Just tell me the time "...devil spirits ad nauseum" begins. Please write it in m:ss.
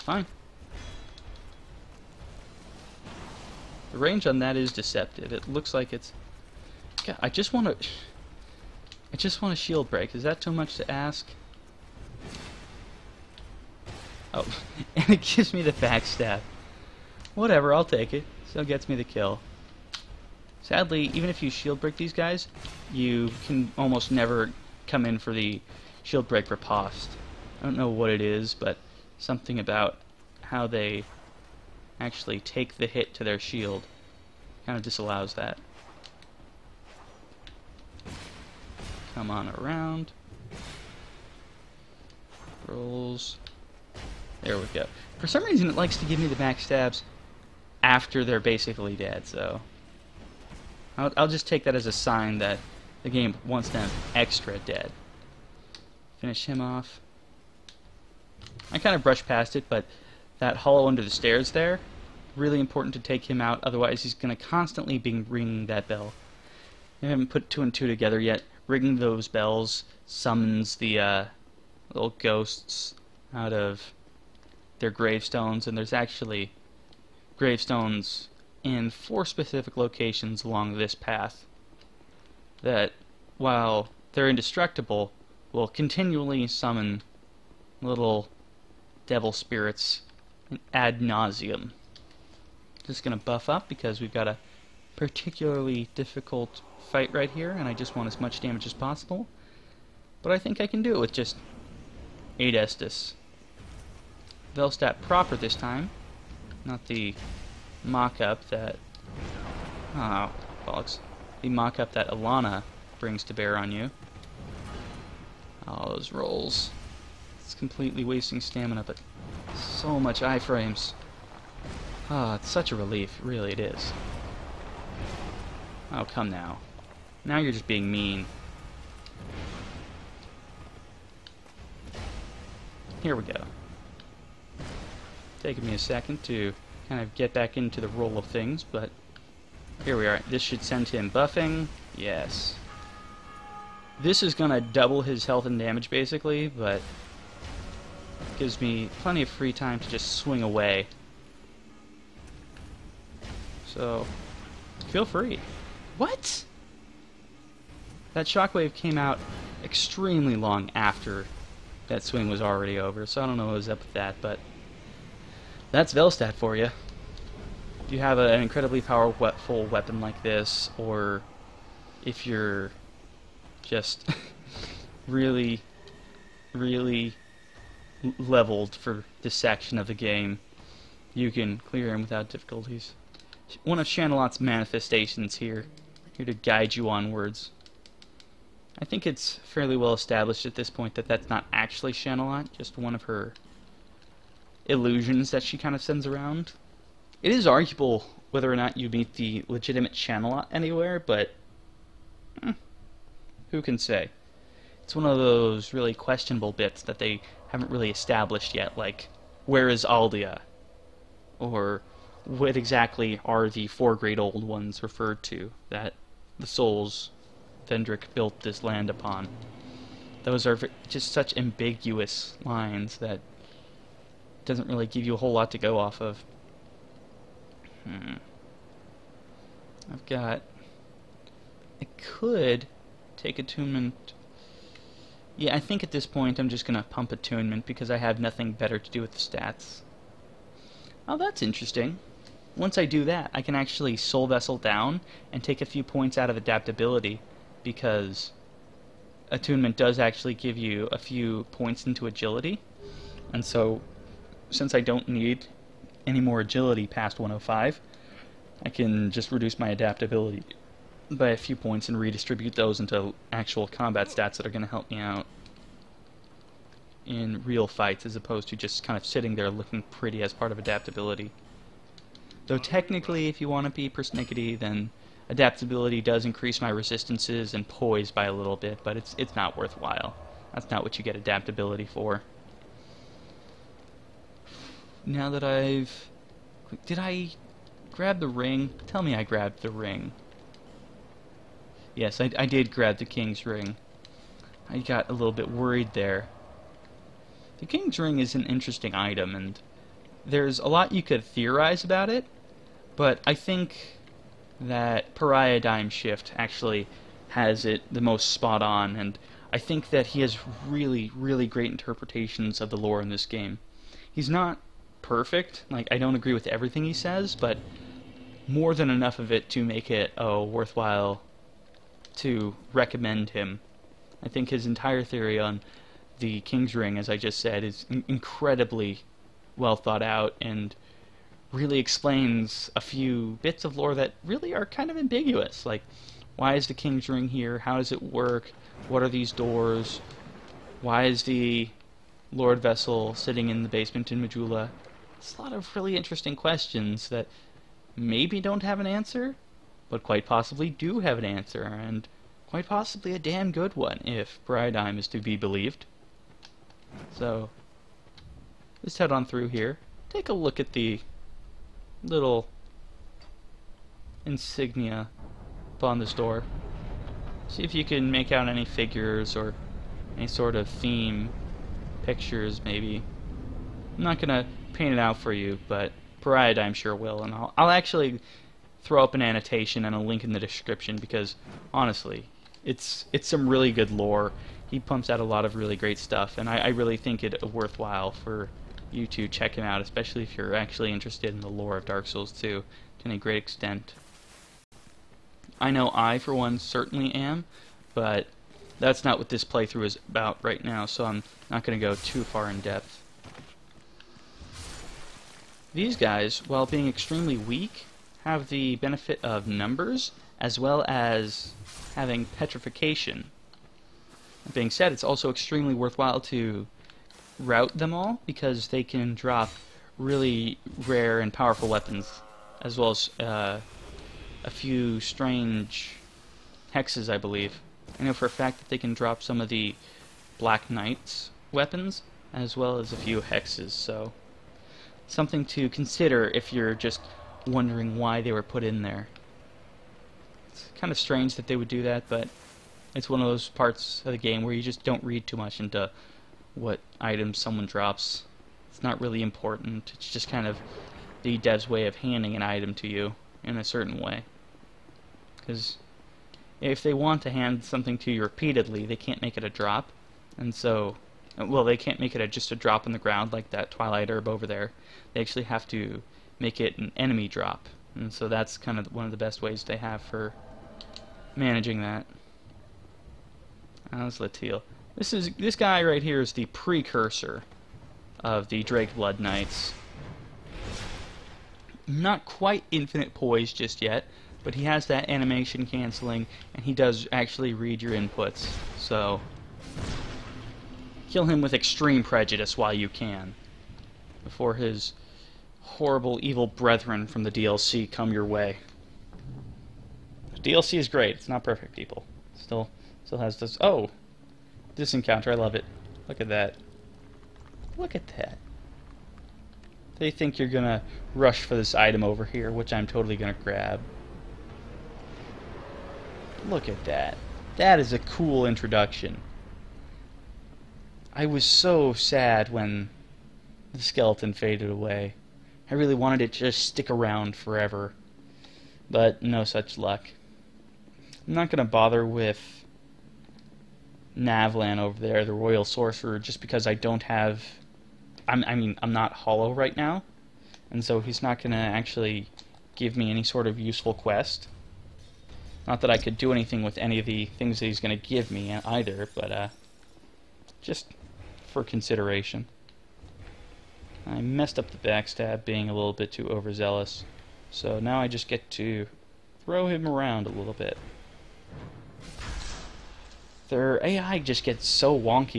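1:29.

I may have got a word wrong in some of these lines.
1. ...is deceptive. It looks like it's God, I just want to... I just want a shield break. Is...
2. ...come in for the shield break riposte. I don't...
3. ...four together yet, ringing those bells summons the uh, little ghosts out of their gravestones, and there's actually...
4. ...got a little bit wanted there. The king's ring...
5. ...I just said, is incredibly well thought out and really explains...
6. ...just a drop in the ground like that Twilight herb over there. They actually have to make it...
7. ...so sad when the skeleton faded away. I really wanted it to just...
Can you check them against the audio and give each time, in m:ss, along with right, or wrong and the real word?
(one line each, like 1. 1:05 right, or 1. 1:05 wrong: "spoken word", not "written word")
1. 0:04 right
2. 0:24 right
3. 1:07 wrong: "two", not "four"
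4. 4:54 wrong: "worried", not "wanted"
5. 5:27 right
6. 7:42 right
7. 8:41 right.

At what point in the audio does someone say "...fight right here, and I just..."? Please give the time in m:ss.
1:36.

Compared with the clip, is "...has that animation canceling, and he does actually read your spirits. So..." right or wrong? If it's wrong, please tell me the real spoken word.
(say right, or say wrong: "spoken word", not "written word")
wrong: "inputs", not "spirits".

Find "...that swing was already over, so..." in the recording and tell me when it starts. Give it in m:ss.
2:41.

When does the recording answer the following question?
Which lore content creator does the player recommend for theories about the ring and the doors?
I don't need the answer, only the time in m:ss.
5:05.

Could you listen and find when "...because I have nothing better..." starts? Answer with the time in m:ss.
3:57.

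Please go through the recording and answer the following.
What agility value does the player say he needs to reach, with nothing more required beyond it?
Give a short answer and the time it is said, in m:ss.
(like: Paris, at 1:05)
105, at 4:17.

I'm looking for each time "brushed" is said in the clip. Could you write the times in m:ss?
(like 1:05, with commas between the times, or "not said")
0:59.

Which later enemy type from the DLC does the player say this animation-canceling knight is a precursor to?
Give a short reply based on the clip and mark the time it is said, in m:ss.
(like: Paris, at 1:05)
Drakeblood Knights, at 7:58.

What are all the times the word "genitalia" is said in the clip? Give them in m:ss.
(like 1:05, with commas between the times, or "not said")
not said.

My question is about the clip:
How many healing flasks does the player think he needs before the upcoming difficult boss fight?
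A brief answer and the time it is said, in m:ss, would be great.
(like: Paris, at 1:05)
8, at 1:42.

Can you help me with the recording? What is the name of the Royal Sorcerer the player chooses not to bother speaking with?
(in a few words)
Navlaan.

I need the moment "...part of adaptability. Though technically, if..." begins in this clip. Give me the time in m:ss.
4:30.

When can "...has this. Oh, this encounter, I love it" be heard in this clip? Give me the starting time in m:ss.
8:23.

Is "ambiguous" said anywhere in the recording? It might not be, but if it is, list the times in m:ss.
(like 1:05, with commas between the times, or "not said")
3:41, 5:34.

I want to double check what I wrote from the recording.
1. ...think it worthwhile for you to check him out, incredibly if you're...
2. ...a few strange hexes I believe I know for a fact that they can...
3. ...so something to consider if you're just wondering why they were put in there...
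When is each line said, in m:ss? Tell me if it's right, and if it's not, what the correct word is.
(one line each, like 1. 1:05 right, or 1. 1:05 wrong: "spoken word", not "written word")
1. 6:26 wrong: "especially", not "incredibly"
2. 7:04 right
3. 7:13 right.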